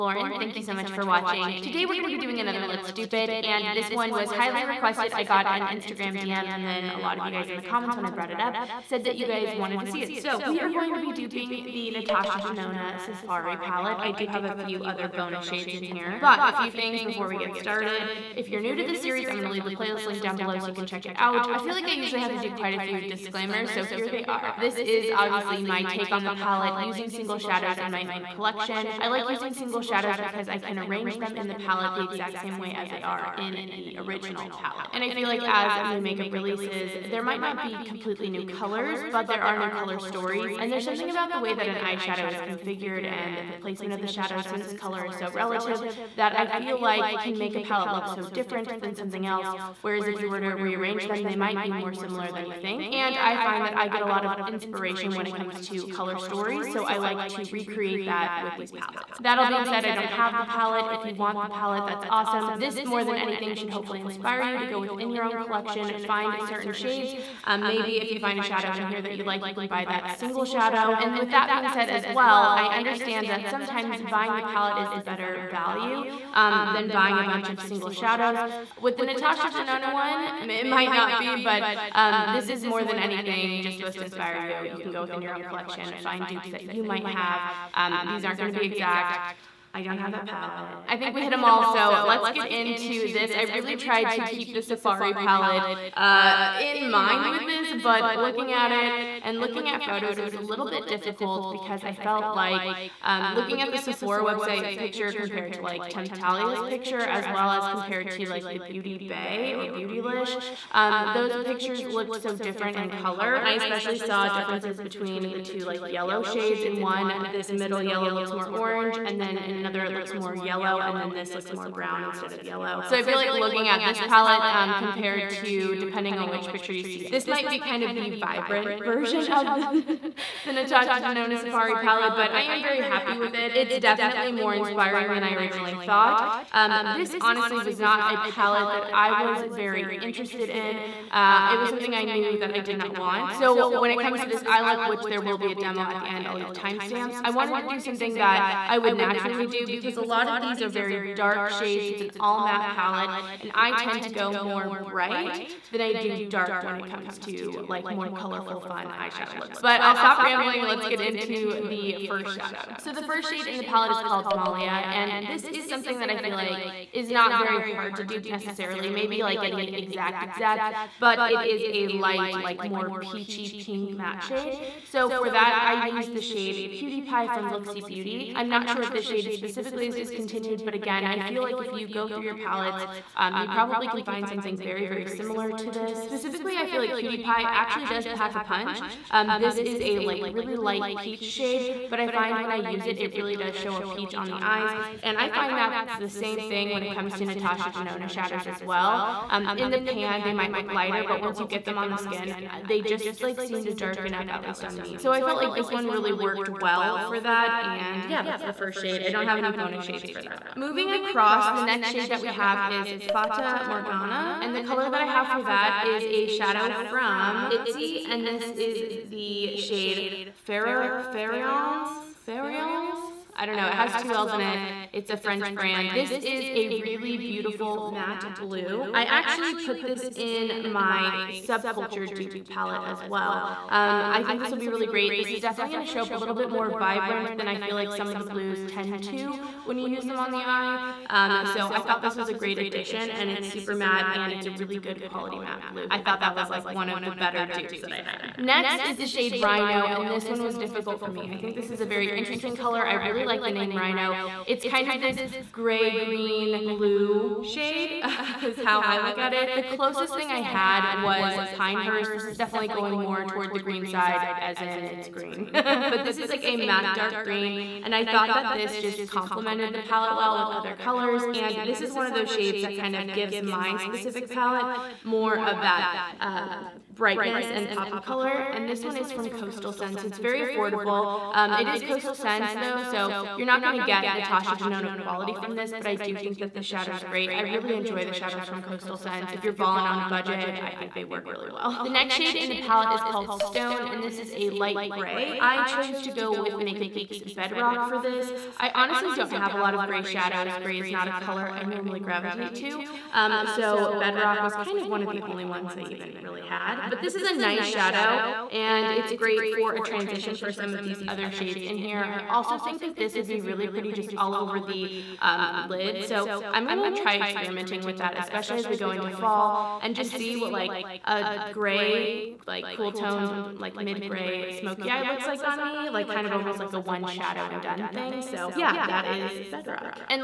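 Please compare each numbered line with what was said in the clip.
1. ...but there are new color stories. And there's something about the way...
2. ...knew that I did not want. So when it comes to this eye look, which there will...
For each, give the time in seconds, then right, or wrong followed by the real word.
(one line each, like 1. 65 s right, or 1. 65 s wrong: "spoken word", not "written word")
1. 39 s right
2. 142 s right.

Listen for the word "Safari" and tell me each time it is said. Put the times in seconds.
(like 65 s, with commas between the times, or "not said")
13 s, 94 s, 131 s.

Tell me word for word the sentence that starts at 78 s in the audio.
With the Natasha Denona one, it might not be, but um, this is more than anything just supposed to inspire you.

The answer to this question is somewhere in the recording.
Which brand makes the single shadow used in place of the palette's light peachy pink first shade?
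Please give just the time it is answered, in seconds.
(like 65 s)
177 s.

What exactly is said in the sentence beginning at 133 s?
It's definitely more inspiring than I originally thought.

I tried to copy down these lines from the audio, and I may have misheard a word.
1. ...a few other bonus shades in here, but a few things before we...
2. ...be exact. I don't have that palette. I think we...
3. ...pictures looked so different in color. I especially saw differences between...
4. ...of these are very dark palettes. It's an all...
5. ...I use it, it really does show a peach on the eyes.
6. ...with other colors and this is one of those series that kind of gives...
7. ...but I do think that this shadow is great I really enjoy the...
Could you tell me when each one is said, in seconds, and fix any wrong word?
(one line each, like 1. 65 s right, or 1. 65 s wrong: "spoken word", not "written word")
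1. 14 s right
2. 88 s right
3. 111 s right
4. 150 s wrong: "shades", not "palettes"
5. 192 s right
6. 270 s wrong: "shades", not "series"
7. 285 s right.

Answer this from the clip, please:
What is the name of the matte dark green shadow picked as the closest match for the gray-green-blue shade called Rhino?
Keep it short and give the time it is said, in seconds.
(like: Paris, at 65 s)
Pinehurst, at 261 s.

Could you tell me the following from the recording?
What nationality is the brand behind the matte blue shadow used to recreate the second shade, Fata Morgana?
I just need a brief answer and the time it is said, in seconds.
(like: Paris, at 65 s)
French, at 225 s.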